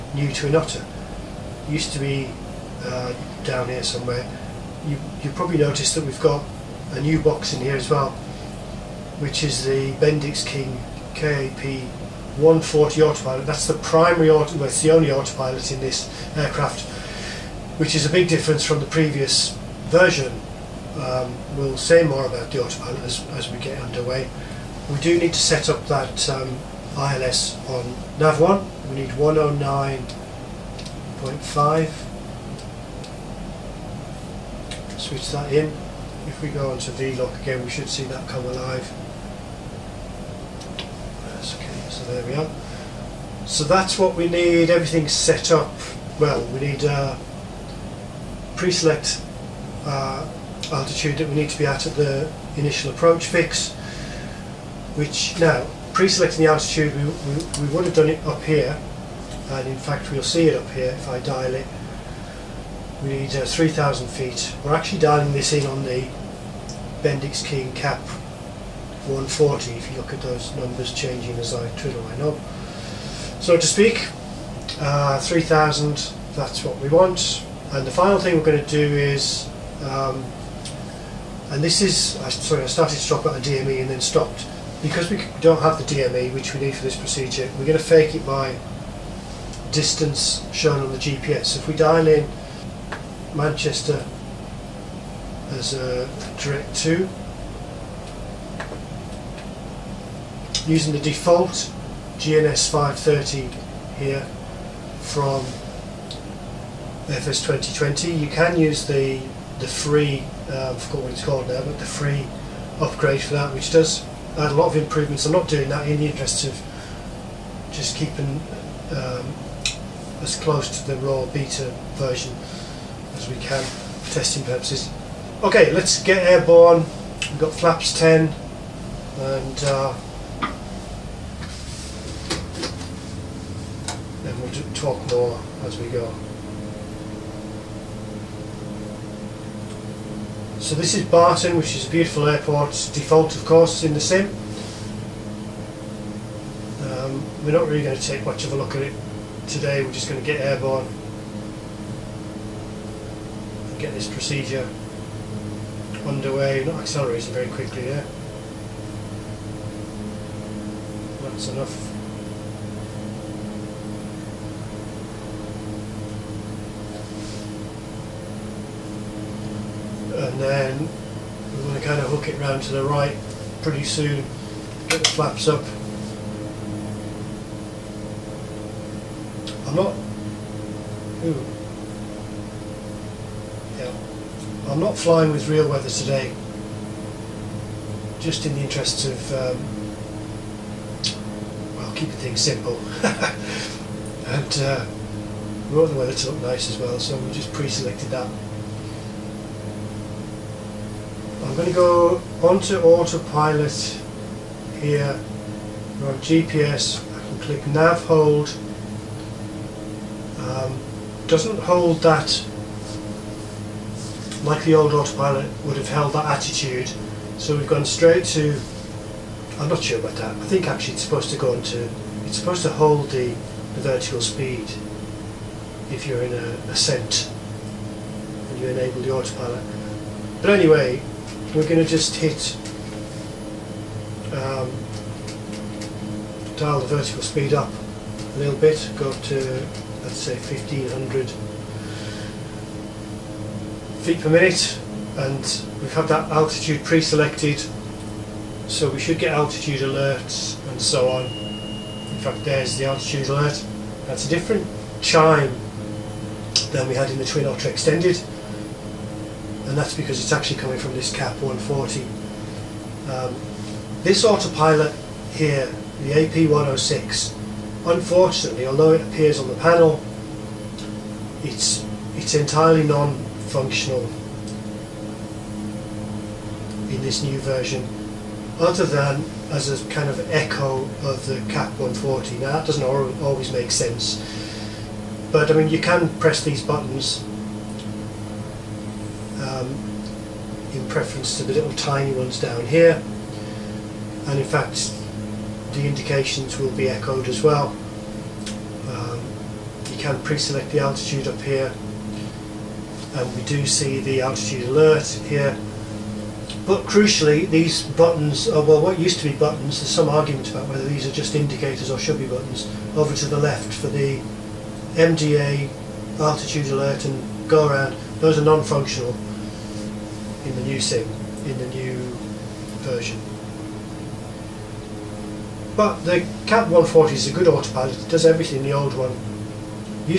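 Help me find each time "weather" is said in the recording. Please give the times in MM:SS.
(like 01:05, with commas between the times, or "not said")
03:05, 03:15.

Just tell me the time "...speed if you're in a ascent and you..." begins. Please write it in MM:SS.
03:44.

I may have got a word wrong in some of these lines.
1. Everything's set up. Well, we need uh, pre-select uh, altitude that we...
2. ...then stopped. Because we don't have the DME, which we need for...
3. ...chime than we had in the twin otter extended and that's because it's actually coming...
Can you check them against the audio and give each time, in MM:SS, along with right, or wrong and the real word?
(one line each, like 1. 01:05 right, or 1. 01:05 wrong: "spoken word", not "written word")
1. 00:44 right
2. 01:23 right
3. 04:14 right.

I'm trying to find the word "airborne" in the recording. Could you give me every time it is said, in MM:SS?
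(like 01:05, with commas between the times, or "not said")
02:06, 02:30.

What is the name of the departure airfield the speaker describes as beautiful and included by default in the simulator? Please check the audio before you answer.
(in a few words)
Barton.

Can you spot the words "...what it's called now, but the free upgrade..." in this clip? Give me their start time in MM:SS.
01:51.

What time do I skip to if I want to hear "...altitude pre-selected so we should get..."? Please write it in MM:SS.
04:06.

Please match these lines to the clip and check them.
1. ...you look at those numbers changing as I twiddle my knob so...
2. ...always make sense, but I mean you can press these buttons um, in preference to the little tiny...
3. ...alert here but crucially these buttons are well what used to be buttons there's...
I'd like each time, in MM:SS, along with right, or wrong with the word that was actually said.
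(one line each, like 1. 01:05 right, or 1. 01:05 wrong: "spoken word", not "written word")
1. 01:09 right
2. 04:43 right
3. 05:04 right.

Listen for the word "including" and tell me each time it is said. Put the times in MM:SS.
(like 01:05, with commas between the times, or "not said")
not said.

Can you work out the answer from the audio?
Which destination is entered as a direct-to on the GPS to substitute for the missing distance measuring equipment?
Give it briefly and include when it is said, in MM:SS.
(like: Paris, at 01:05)
Manchester, at 01:33.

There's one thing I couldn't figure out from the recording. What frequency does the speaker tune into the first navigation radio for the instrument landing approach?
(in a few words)
109.5.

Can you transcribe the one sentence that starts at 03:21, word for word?
going to go onto autopilot here.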